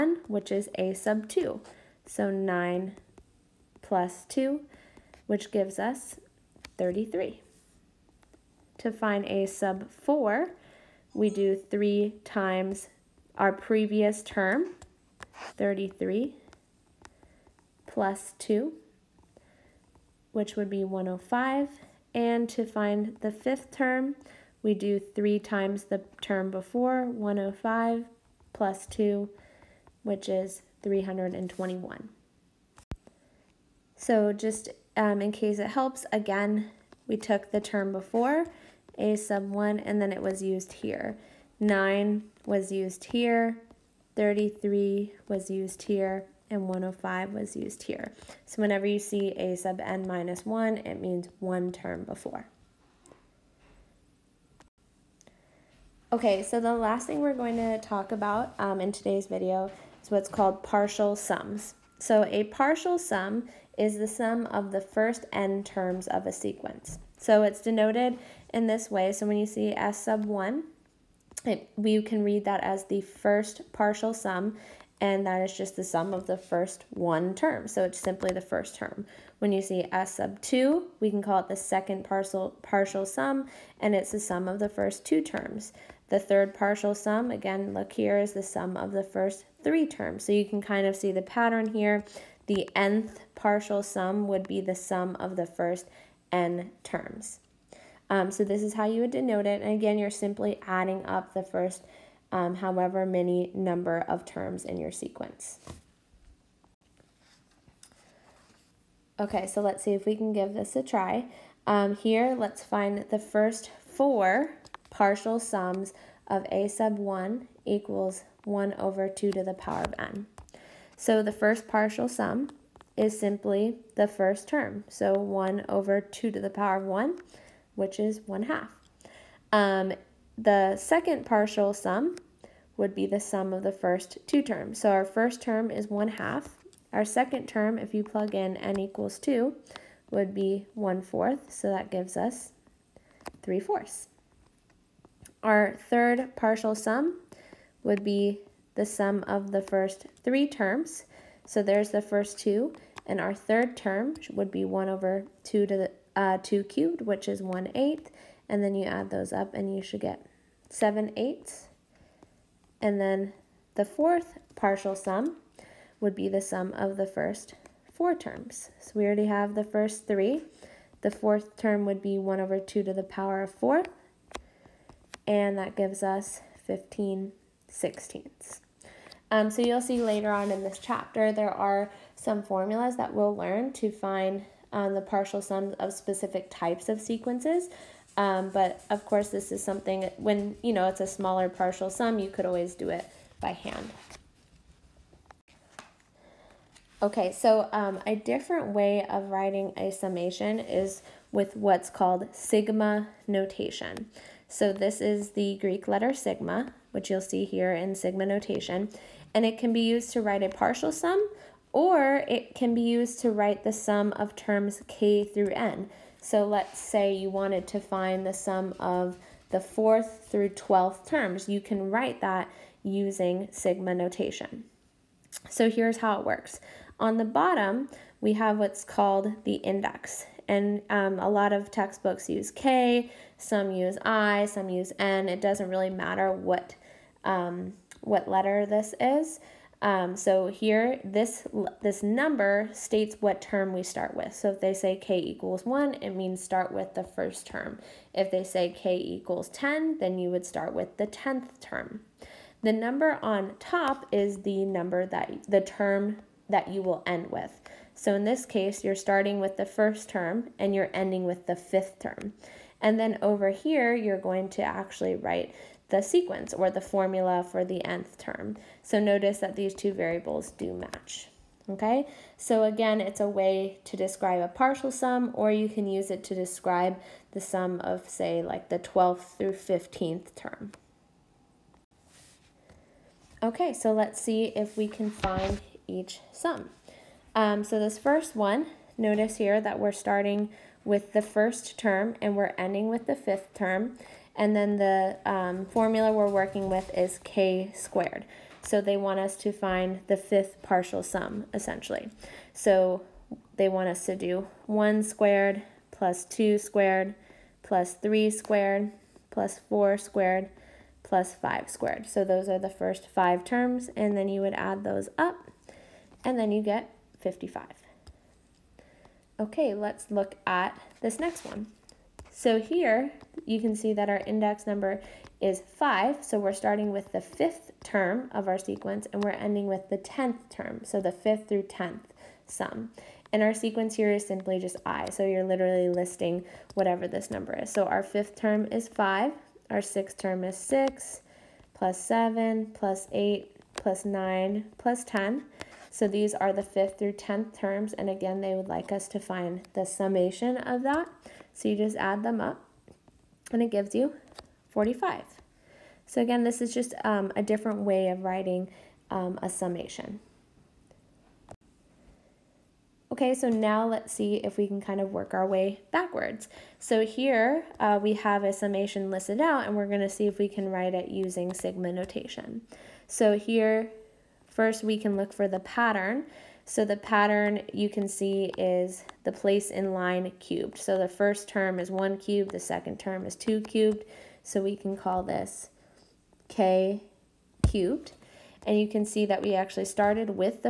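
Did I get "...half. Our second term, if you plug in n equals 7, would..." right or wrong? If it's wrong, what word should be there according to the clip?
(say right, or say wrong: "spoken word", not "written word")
wrong: "2", not "7".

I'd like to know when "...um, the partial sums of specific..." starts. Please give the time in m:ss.
3:04.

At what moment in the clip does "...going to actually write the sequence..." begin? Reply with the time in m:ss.
4:24.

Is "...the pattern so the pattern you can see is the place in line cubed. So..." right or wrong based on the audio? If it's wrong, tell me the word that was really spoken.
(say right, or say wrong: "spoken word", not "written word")
right.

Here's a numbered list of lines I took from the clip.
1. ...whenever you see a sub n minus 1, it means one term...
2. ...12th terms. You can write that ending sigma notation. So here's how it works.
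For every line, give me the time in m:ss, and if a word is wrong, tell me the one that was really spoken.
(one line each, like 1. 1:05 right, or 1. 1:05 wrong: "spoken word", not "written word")
1. 0:48 right
2. 3:40 wrong: "using", not "ending".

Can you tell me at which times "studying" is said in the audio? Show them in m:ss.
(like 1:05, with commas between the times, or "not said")
not said.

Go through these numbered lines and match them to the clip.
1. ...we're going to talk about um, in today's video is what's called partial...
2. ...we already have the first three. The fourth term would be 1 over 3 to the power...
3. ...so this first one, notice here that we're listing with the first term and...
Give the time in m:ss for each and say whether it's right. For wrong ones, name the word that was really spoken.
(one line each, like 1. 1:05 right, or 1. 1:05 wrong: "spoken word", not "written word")
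1. 0:57 right
2. 2:48 wrong: "2", not "3"
3. 4:47 wrong: "starting", not "listing".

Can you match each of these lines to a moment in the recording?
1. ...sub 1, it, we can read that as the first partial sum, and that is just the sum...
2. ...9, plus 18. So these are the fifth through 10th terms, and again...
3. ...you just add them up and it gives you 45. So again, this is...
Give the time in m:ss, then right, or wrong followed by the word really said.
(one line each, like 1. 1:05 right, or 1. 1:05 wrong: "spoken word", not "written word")
1. 1:10 right
2. 5:44 wrong: "10", not "18"
3. 5:51 right.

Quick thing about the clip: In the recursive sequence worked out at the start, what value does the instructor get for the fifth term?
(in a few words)
321.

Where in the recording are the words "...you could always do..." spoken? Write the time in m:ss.
3:12.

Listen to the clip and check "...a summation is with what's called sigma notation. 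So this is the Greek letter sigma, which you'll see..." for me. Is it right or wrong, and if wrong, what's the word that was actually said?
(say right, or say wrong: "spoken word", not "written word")
right.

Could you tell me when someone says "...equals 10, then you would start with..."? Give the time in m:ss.
4:08.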